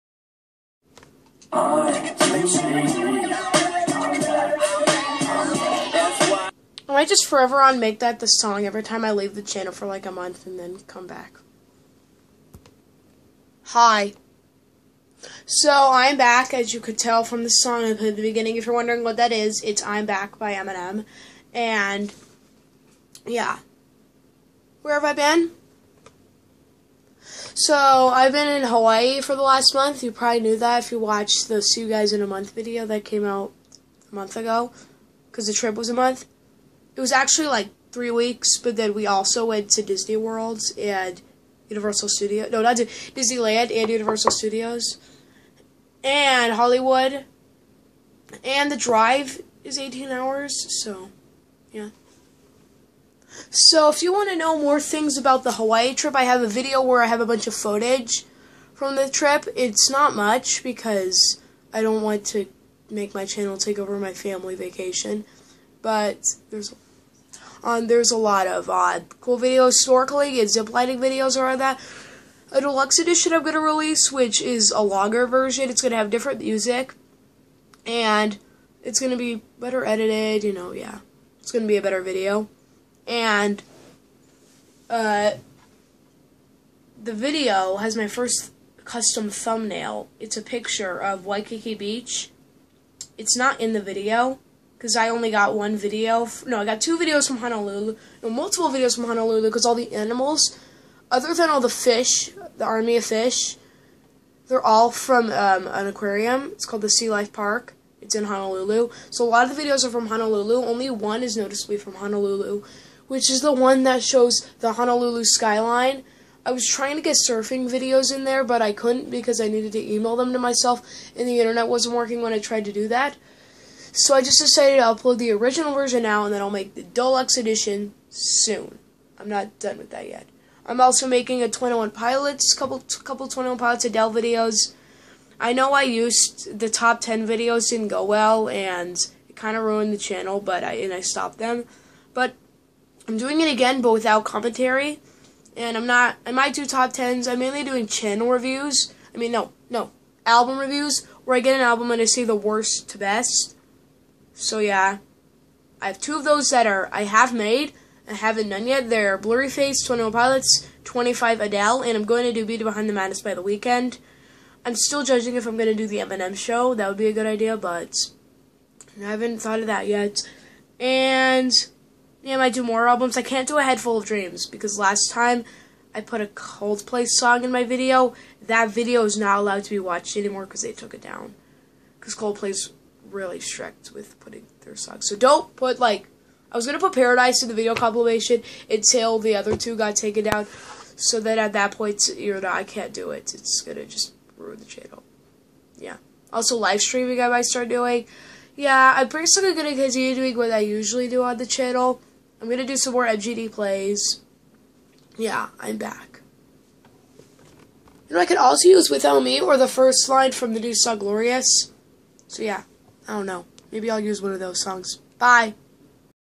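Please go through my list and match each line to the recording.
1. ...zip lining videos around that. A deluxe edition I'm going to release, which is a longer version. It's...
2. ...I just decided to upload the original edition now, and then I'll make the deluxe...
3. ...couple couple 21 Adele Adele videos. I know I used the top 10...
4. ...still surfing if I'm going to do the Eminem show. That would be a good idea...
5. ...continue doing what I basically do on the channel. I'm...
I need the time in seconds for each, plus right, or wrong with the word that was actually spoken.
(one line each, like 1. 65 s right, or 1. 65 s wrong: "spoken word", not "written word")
1. 70 s right
2. 124 s wrong: "version", not "edition"
3. 132 s wrong: "Pilots", not "Adele"
4. 164 s wrong: "judging", not "surfing"
5. 199 s wrong: "usually", not "basically".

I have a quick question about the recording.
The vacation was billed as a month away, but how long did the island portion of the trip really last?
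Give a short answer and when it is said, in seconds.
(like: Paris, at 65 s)
3 weeks, at 37 s.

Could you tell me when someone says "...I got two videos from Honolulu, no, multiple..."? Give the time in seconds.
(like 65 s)
96 s.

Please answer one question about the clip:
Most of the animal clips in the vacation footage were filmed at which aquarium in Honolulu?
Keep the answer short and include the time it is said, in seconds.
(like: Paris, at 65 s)
Sea Life Park, at 106 s.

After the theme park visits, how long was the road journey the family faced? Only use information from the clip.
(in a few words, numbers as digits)
18 hours.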